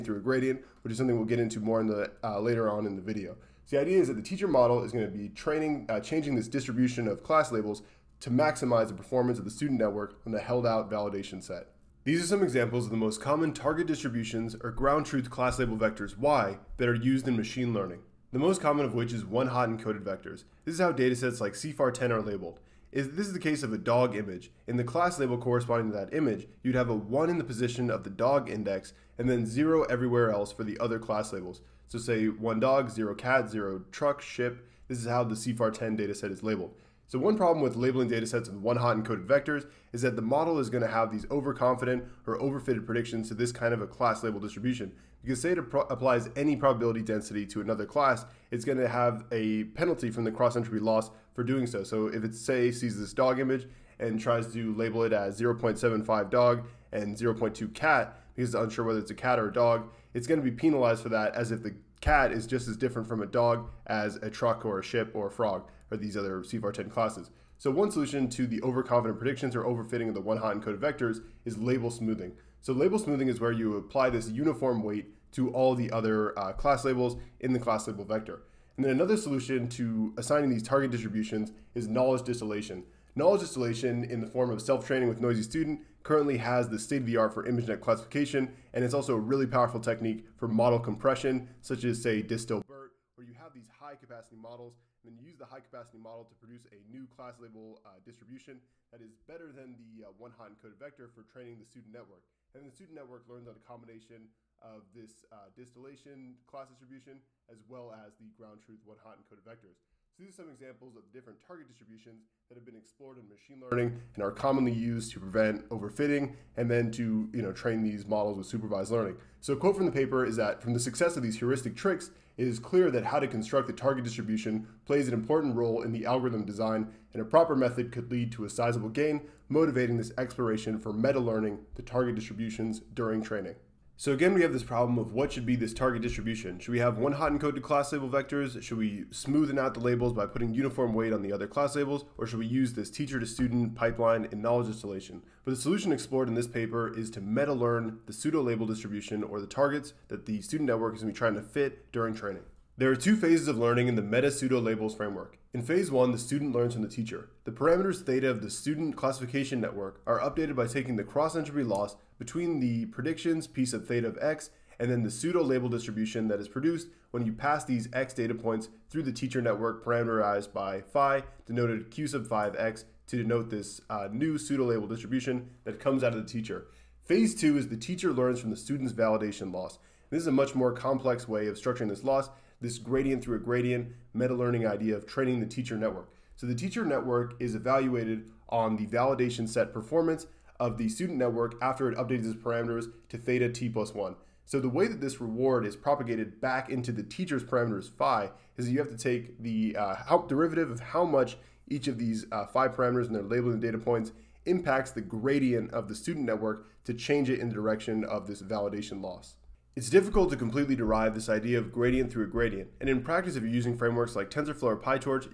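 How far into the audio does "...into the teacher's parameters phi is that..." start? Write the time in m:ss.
3:16.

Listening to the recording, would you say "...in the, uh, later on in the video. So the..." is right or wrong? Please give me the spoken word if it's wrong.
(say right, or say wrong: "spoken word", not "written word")
right.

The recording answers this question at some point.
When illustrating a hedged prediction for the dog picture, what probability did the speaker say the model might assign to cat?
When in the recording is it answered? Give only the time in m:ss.
0:57.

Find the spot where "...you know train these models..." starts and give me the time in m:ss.
1:57.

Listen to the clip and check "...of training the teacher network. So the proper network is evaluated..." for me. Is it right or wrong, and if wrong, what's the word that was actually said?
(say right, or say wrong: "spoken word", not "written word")
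wrong: "teacher", not "proper".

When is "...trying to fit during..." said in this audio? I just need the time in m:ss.
2:31.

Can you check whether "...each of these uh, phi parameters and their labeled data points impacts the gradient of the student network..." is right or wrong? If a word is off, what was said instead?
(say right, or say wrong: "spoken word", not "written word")
right.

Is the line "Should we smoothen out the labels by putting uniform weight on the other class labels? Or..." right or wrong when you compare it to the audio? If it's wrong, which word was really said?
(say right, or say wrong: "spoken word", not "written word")
right.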